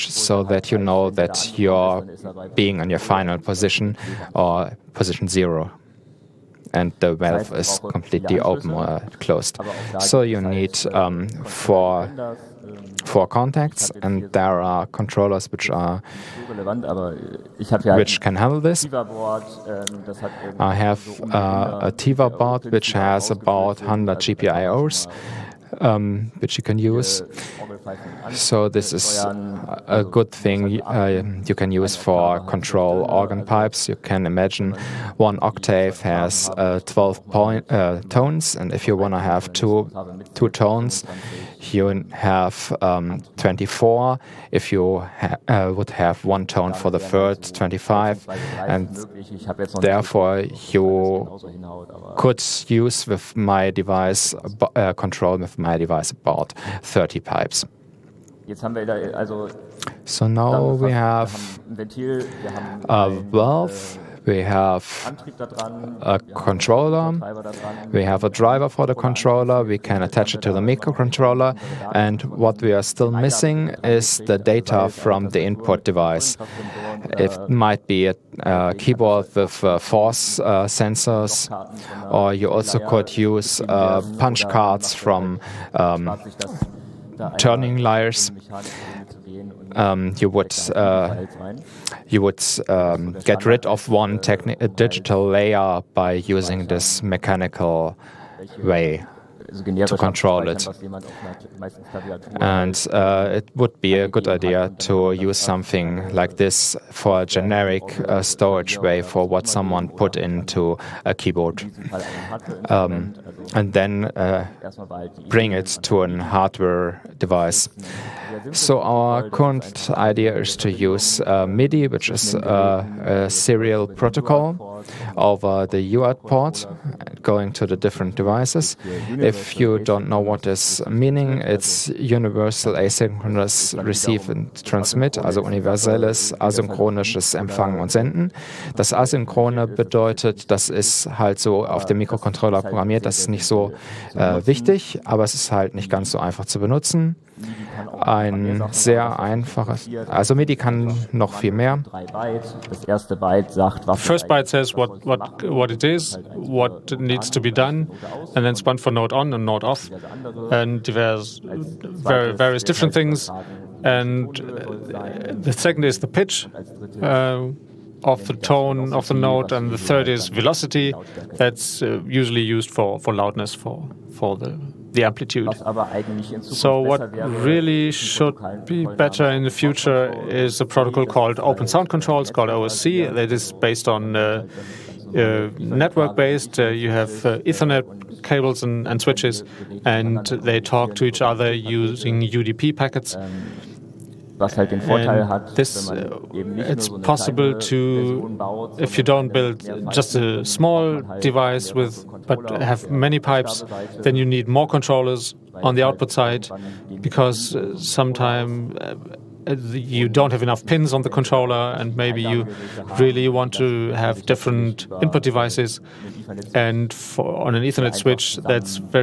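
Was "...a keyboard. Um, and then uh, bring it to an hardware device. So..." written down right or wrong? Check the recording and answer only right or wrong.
right.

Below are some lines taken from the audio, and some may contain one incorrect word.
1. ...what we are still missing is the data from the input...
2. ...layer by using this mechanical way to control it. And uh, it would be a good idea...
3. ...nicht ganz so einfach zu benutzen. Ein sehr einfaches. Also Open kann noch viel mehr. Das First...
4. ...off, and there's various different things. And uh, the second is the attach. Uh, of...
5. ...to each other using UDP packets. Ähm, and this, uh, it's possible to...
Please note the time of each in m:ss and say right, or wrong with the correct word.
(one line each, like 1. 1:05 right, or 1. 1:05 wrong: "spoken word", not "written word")
1. 1:12 right
2. 1:35 right
3. 2:25 wrong: "MIDI", not "Open"
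4. 2:39 wrong: "pitch", not "attach"
5. 3:10 right.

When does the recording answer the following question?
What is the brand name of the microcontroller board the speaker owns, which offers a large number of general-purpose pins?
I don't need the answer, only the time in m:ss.
0:21.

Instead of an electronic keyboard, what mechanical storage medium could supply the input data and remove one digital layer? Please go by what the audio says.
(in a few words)
Punch cards.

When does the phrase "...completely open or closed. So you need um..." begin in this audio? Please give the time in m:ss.
0:07.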